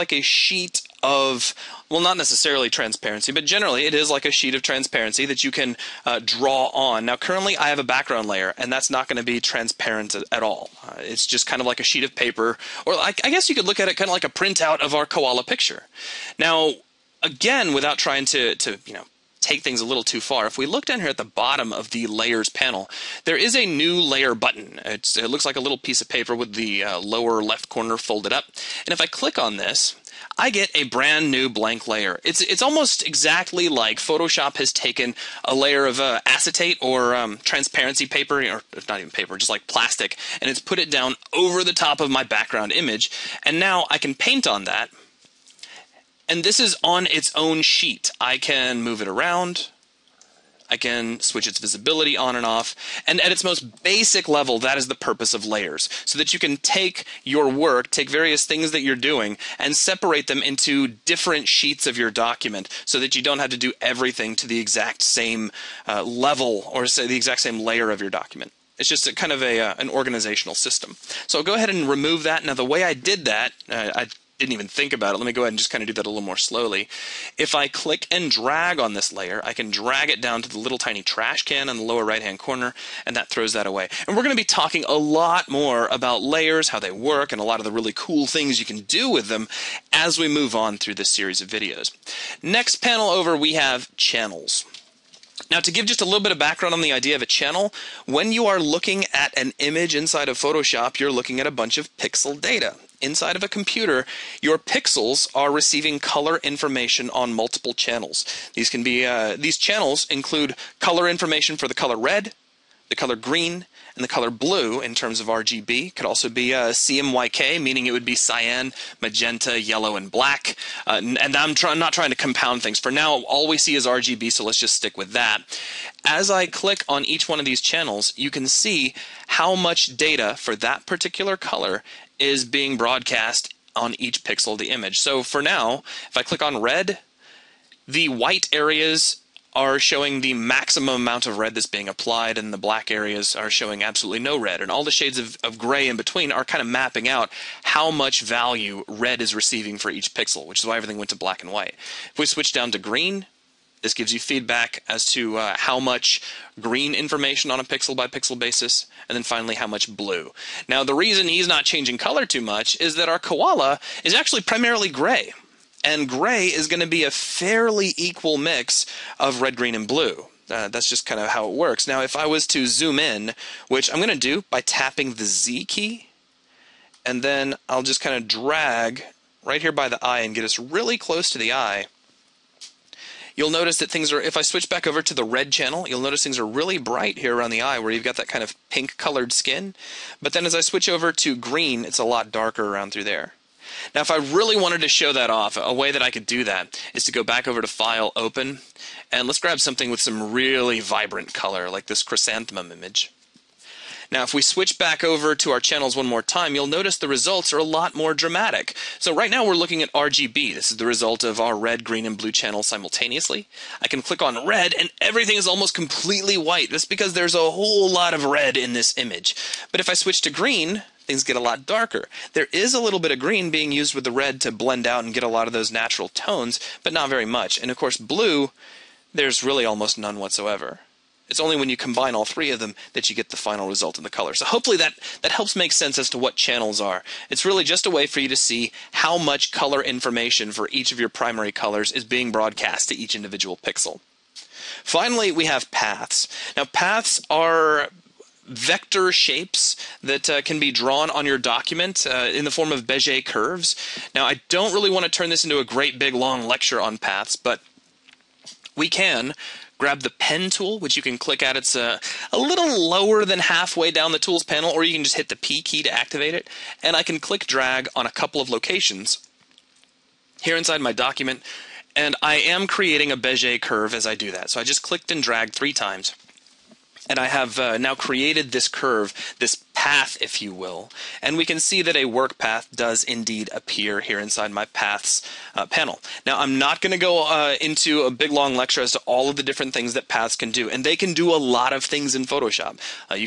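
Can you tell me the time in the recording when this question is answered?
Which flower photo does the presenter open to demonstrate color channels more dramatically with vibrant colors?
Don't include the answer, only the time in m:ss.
3:22.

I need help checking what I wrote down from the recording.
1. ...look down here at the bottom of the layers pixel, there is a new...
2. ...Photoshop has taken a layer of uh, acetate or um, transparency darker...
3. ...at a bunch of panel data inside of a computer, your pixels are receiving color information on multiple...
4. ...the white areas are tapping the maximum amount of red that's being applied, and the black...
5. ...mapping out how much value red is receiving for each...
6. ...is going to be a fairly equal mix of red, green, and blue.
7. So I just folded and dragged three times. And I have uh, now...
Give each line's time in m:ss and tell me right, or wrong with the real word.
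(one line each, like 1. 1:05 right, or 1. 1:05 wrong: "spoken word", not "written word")
1. 0:20 wrong: "panel", not "pixel"
2. 0:33 wrong: "paper", not "darker"
3. 1:41 wrong: "pixel", not "panel"
4. 2:17 wrong: "showing", not "tapping"
5. 2:26 right
6. 2:46 right
7. 4:34 wrong: "clicked", not "folded".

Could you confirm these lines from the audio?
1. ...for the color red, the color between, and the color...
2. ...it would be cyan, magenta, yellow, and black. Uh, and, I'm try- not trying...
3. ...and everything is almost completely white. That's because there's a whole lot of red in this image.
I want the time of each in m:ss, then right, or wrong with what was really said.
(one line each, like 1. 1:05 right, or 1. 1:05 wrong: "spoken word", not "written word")
1. 1:51 wrong: "green", not "between"
2. 1:57 right
3. 3:34 right.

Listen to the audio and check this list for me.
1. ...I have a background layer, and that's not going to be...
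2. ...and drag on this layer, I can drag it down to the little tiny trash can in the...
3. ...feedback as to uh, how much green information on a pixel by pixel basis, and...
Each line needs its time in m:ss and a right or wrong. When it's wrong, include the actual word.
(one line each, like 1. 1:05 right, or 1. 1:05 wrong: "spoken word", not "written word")
1. 0:07 right
2. 1:18 right
3. 2:34 right.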